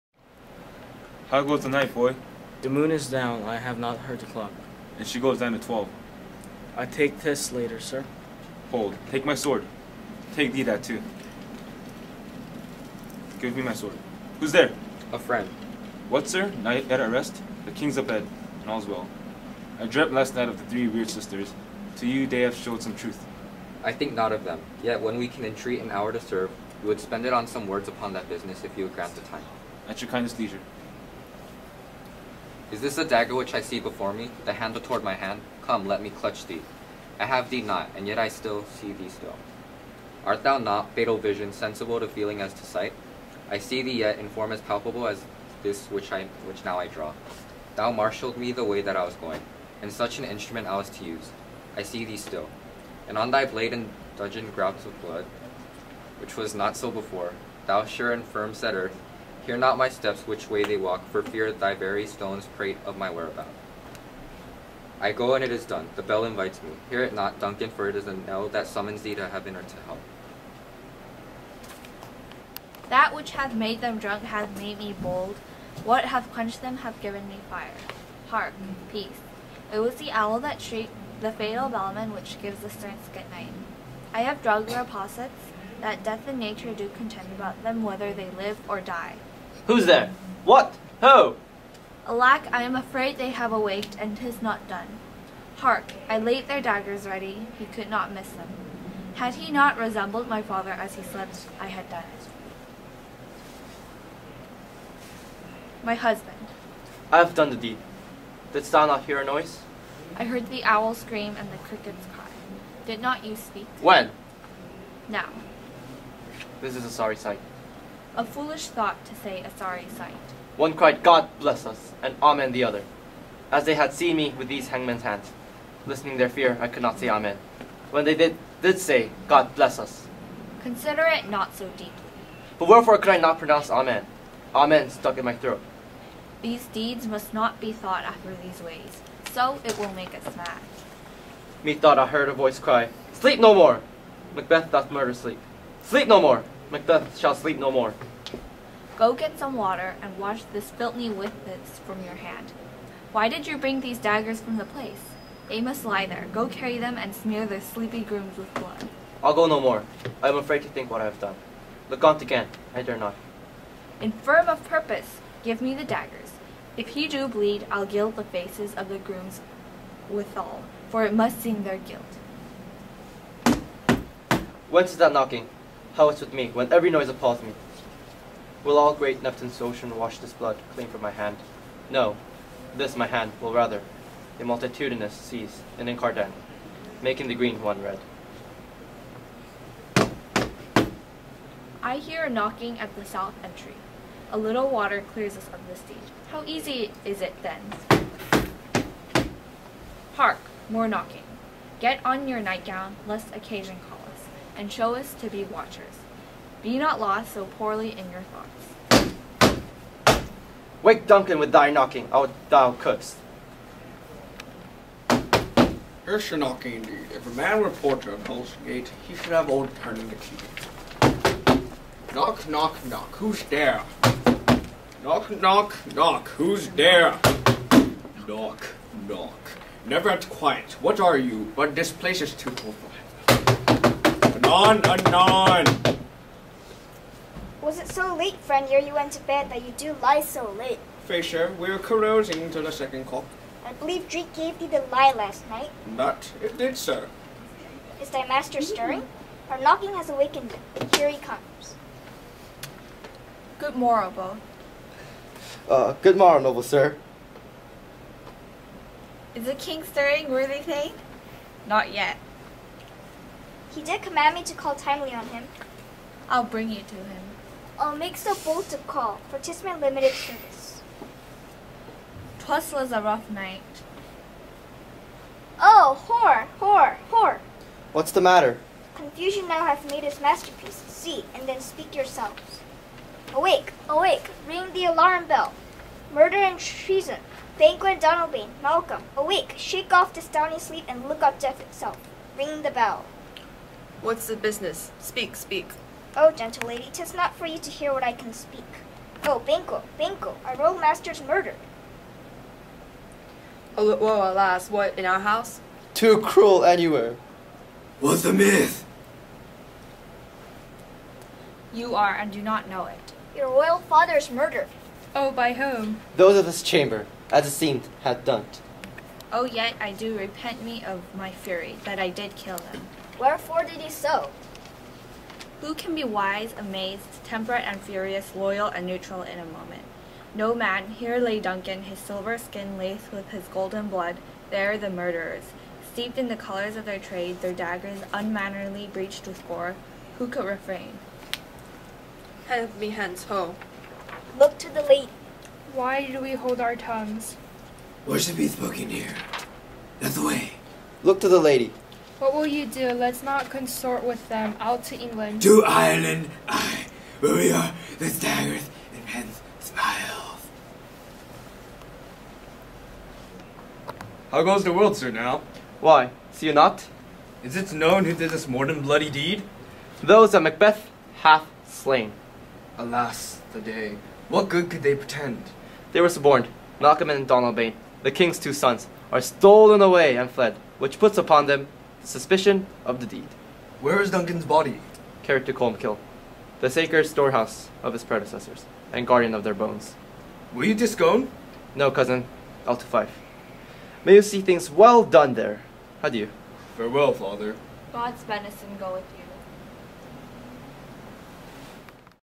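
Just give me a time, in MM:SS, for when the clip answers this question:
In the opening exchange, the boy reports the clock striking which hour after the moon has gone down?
00:05.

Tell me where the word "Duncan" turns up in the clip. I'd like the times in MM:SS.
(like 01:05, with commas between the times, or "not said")
01:07, 03:31, 05:31, 06:24.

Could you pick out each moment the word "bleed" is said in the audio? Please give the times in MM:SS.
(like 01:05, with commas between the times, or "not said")
02:47.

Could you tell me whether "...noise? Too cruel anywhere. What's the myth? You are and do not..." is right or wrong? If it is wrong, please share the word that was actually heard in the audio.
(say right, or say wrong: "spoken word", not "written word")
wrong: "house", not "noise".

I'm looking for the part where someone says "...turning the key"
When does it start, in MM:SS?
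03:39.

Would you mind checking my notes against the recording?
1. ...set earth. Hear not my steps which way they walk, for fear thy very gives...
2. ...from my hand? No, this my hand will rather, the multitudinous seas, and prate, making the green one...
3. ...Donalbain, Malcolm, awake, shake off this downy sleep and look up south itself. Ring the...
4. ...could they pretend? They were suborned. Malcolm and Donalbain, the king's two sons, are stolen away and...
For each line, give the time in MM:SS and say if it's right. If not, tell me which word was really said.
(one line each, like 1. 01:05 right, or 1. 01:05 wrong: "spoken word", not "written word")
1. 00:58 wrong: "stones", not "gives"
2. 03:00 wrong: "incarnate", not "prate"
3. 04:47 wrong: "death", not "south"
4. 06:14 right.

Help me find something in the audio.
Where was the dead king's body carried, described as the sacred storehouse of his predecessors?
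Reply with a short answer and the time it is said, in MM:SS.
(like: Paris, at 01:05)
Colmkill, at 06:25.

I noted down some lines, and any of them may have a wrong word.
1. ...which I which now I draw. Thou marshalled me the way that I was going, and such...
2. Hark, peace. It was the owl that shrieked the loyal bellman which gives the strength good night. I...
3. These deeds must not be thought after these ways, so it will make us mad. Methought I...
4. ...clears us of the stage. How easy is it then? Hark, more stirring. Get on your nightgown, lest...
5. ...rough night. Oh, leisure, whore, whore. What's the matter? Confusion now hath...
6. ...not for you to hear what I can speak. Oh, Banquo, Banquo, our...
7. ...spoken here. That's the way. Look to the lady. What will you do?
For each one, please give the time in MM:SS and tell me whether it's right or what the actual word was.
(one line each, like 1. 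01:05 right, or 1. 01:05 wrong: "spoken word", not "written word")
1. 00:45 right
2. 01:18 wrong: "fatal", not "loyal"
3. 02:16 right
4. 03:15 wrong: "knocking", not "stirring"
5. 04:33 wrong: "whore", not "leisure"
6. 04:57 right
7. 05:48 right.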